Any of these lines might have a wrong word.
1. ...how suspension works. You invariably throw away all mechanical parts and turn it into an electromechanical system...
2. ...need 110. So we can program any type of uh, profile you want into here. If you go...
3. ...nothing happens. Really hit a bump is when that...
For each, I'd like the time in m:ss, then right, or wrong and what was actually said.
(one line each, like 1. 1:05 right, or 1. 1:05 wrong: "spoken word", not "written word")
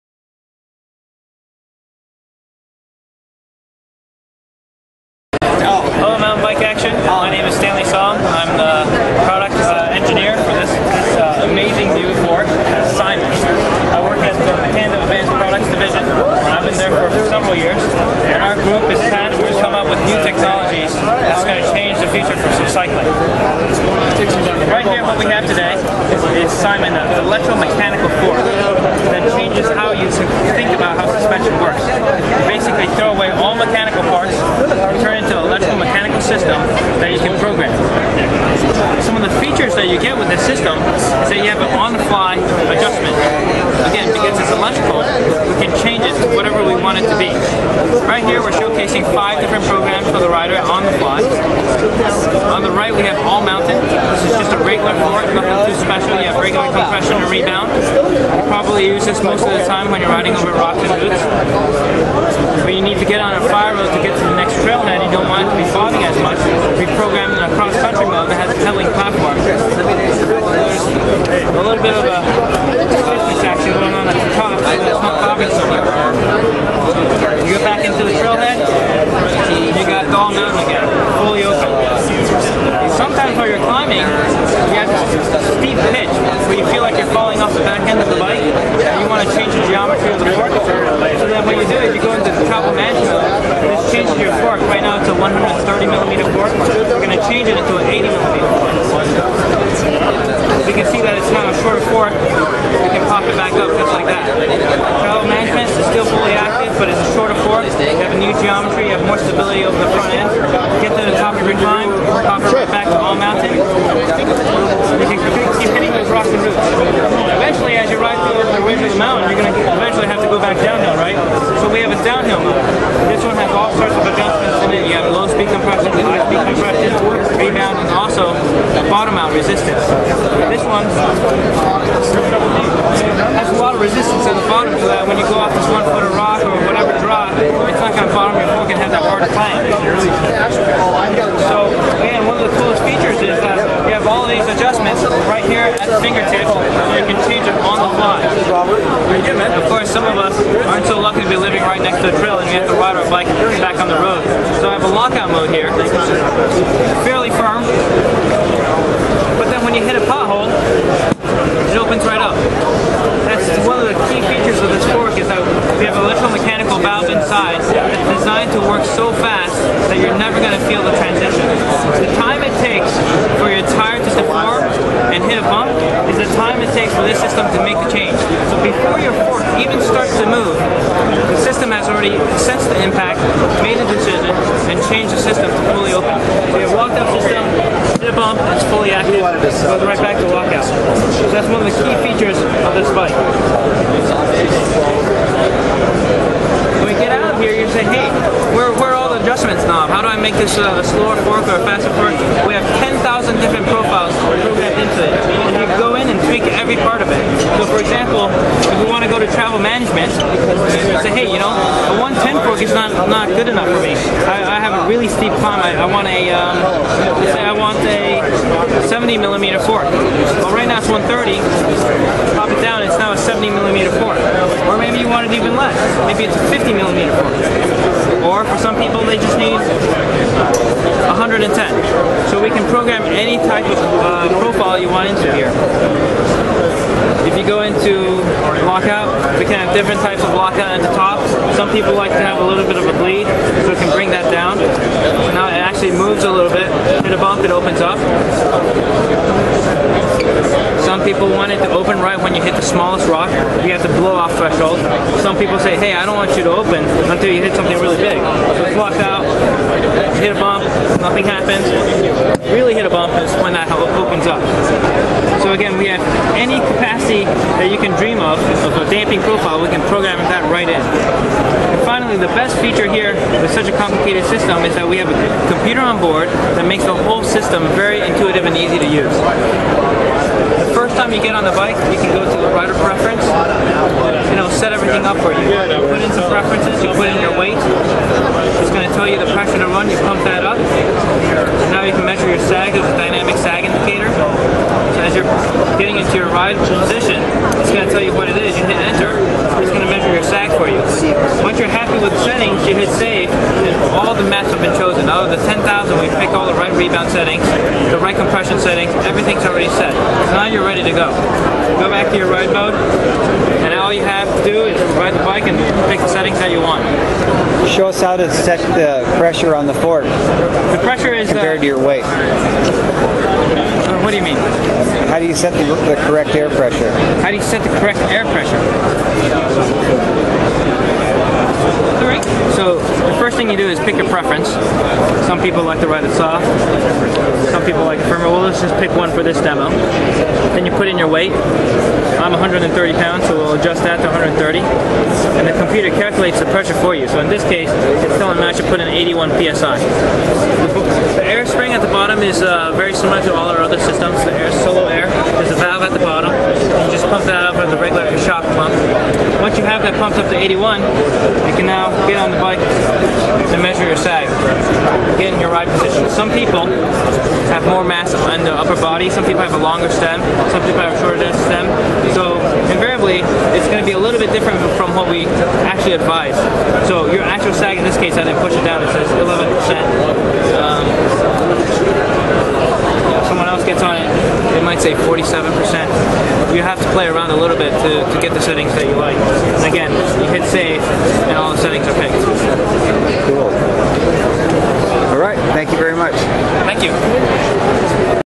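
1. 0:30 wrong: "basically", not "invariably"
2. 3:49 right
3. 4:21 right.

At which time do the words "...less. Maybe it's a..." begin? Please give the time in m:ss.
3:45.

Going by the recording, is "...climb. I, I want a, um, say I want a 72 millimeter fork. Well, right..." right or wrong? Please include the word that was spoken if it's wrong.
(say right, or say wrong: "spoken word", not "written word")
wrong: "70", not "72".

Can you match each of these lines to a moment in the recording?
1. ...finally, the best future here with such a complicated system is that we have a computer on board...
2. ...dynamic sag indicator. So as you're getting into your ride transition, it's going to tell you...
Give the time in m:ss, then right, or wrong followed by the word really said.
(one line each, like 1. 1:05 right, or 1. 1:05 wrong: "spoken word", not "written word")
1. 4:31 wrong: "feature", not "future"
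2. 4:52 wrong: "position", not "transition".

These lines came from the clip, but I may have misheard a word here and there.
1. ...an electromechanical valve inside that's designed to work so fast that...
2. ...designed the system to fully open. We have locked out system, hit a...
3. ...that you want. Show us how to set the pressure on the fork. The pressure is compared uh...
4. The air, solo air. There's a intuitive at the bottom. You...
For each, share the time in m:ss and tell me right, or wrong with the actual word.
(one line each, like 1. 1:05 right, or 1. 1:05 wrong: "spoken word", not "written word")
1. 2:45 right
2. 3:04 wrong: "changed", not "designed"
3. 5:16 right
4. 5:54 wrong: "valve", not "intuitive".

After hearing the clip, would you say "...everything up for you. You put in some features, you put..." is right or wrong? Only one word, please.
wrong.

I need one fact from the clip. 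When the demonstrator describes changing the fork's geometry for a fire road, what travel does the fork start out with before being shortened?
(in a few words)
130 millimeter.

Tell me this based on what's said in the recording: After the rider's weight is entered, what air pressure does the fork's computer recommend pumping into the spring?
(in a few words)
81 psi.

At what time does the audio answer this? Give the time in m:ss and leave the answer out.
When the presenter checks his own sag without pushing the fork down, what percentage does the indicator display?
6:19.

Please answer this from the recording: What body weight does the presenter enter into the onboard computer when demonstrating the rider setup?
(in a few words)
130 pounds.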